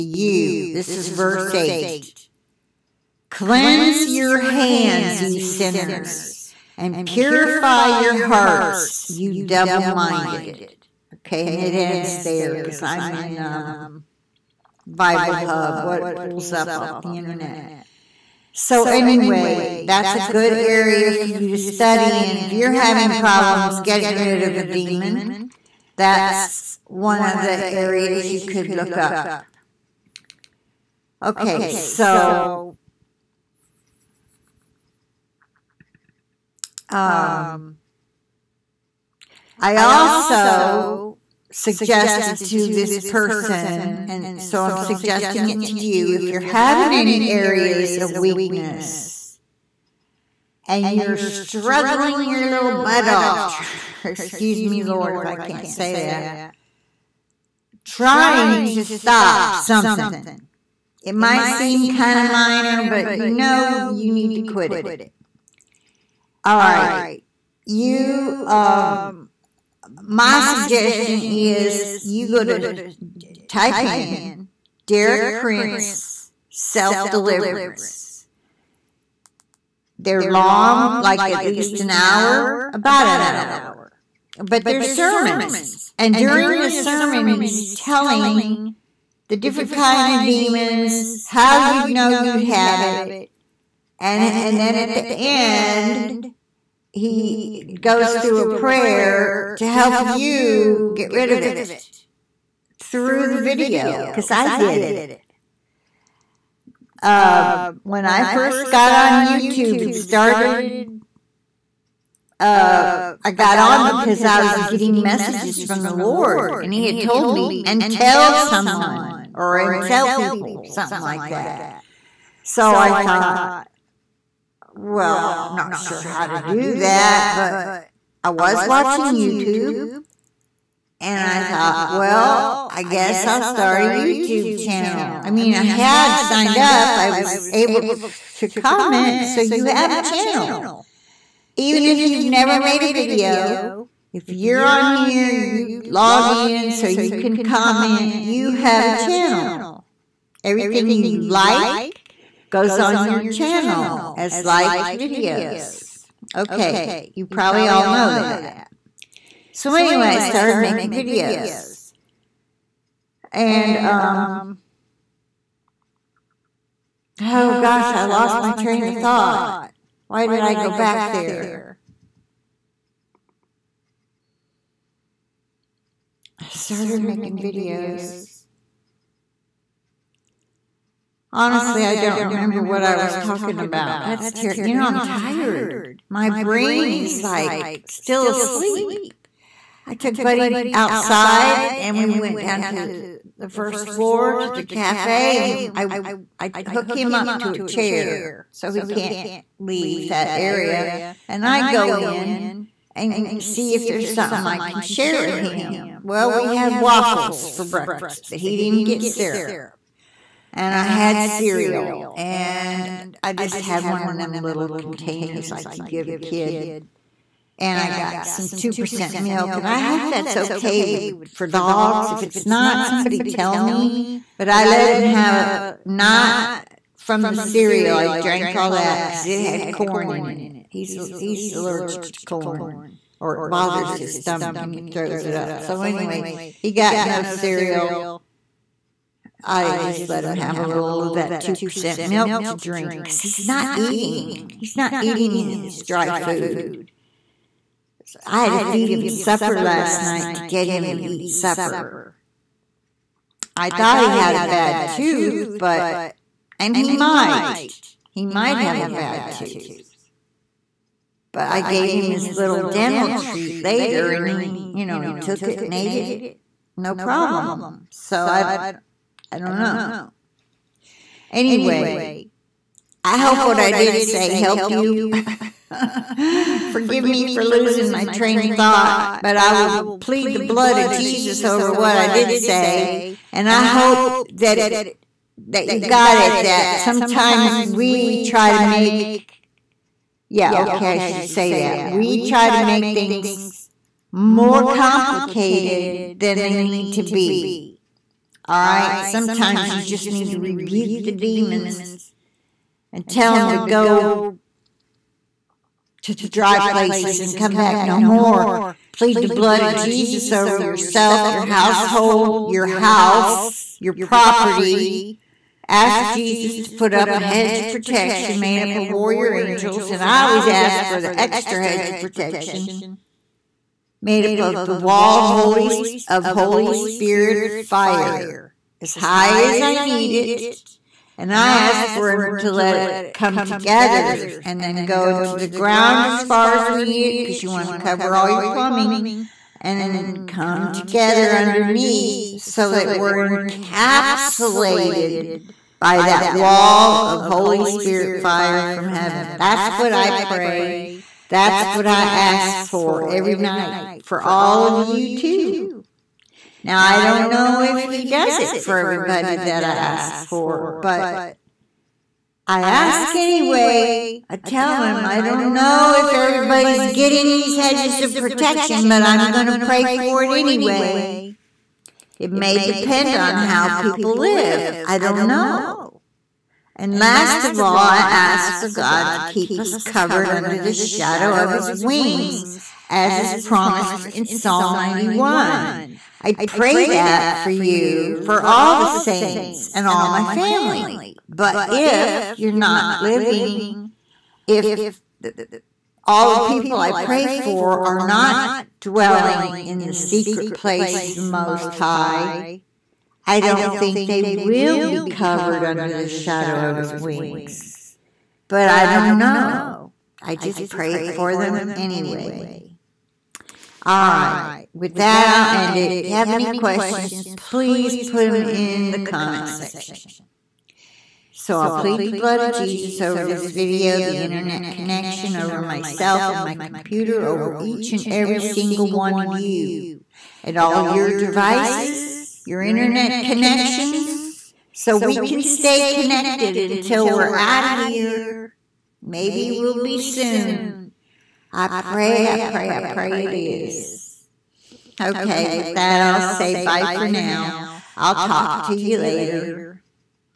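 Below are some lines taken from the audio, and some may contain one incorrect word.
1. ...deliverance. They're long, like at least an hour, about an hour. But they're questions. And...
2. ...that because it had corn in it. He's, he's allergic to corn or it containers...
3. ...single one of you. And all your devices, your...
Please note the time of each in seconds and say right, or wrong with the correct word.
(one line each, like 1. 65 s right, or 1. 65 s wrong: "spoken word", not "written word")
1. 77 s wrong: "sermons", not "questions"
2. 228 s wrong: "bothers", not "containers"
3. 428 s right.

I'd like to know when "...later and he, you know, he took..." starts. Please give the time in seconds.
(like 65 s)
263 s.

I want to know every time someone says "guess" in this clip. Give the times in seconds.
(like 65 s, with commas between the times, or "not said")
132 s.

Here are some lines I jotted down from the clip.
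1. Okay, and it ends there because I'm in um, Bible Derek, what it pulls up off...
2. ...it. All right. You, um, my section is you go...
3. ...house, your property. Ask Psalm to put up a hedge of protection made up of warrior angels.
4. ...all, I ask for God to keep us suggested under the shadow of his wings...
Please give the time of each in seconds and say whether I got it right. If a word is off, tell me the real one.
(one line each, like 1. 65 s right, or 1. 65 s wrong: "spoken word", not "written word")
1. 11 s wrong: "Hub", not "Derek"
2. 64 s wrong: "suggestion", not "section"
3. 312 s wrong: "Jesus", not "Psalm"
4. 377 s wrong: "covered", not "suggested".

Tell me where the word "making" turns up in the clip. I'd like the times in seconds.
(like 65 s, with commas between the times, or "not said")
160 s, 177 s.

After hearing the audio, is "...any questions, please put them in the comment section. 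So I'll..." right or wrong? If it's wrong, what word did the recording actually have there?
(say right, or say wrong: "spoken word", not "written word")
right.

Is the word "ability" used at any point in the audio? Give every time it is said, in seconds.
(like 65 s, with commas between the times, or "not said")
not said.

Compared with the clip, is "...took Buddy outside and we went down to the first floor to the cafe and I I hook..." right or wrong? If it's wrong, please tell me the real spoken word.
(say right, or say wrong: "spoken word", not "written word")
right.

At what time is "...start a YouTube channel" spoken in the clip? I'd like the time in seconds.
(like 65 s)
133 s.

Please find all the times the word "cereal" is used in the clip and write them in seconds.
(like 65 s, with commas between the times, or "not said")
211 s, 227 s, 237 s.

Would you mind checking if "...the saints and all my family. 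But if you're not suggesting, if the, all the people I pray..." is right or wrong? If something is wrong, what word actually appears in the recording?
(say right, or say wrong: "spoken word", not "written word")
wrong: "living", not "suggesting".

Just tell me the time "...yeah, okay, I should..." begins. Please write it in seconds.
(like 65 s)
290 s.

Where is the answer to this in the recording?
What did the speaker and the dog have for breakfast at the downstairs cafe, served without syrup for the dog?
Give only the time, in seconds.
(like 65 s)
206 s.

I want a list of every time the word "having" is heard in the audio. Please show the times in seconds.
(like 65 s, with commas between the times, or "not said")
22 s, 46 s.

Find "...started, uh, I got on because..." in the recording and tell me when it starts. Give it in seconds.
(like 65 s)
109 s.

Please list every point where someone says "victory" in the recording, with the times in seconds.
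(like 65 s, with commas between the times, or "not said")
not said.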